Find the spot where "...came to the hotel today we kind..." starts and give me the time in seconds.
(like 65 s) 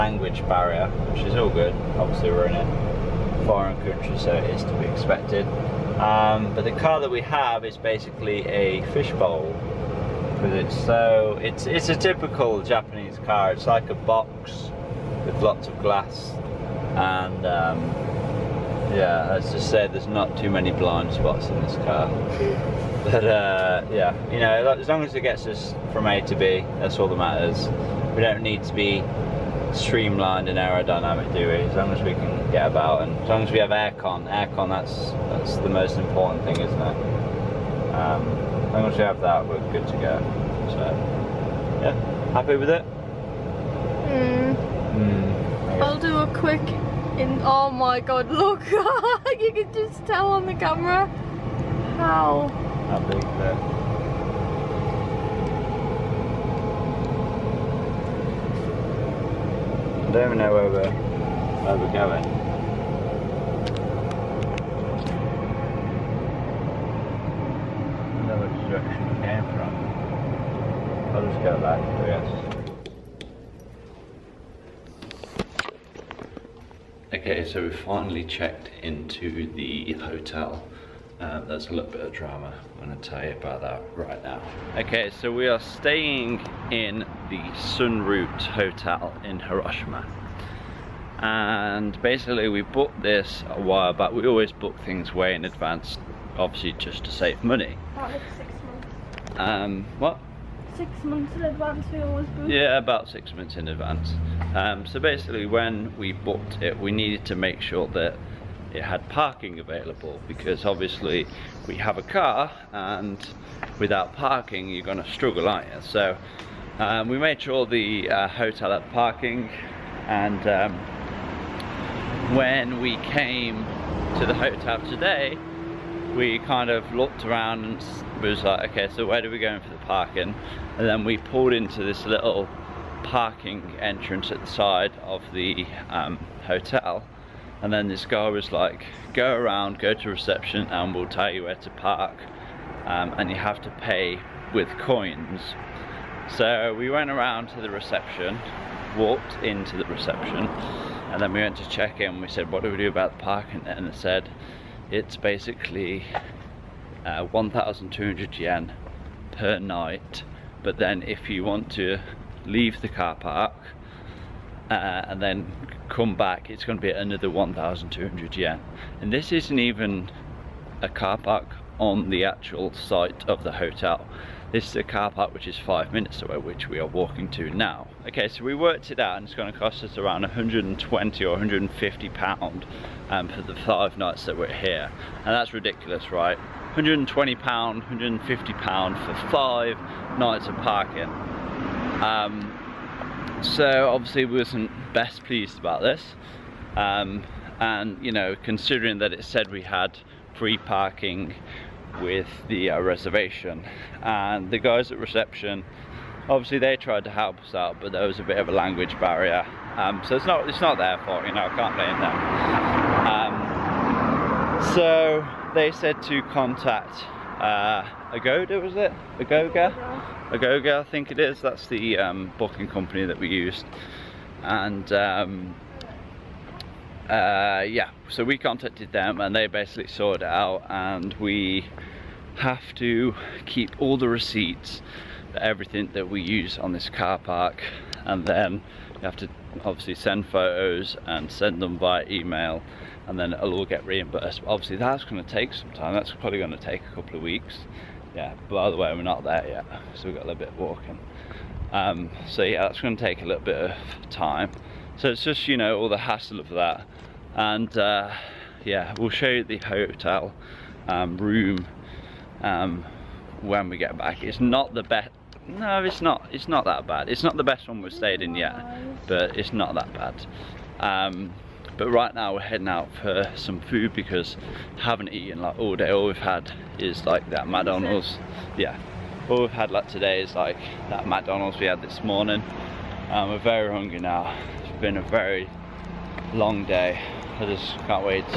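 122 s.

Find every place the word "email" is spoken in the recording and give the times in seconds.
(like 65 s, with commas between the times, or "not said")
242 s.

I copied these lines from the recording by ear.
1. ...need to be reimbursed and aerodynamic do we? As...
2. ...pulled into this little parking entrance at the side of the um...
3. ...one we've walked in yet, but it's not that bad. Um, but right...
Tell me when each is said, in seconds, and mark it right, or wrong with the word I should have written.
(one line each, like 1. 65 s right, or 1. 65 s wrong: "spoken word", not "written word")
1. 28 s wrong: "streamlined", not "reimbursed"
2. 131 s right
3. 267 s wrong: "stayed", not "walked".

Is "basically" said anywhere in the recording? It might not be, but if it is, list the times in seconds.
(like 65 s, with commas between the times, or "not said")
7 s, 92 s, 104 s, 155 s, 229 s.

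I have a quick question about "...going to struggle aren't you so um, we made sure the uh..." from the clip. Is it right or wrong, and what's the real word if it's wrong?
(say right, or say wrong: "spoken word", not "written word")
right.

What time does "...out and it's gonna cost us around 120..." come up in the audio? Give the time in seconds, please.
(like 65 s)
178 s.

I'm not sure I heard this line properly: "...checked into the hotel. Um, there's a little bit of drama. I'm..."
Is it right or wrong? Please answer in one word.
right.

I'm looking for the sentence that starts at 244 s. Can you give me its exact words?
But obviously that's going to take some time, that's probably going to take a couple of weeks.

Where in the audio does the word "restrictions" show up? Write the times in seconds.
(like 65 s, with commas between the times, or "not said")
not said.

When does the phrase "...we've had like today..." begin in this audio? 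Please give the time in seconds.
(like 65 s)
279 s.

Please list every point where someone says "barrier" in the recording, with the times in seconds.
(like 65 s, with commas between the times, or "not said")
0 s, 208 s.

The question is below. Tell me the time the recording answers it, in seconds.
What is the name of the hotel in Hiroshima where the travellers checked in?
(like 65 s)
87 s.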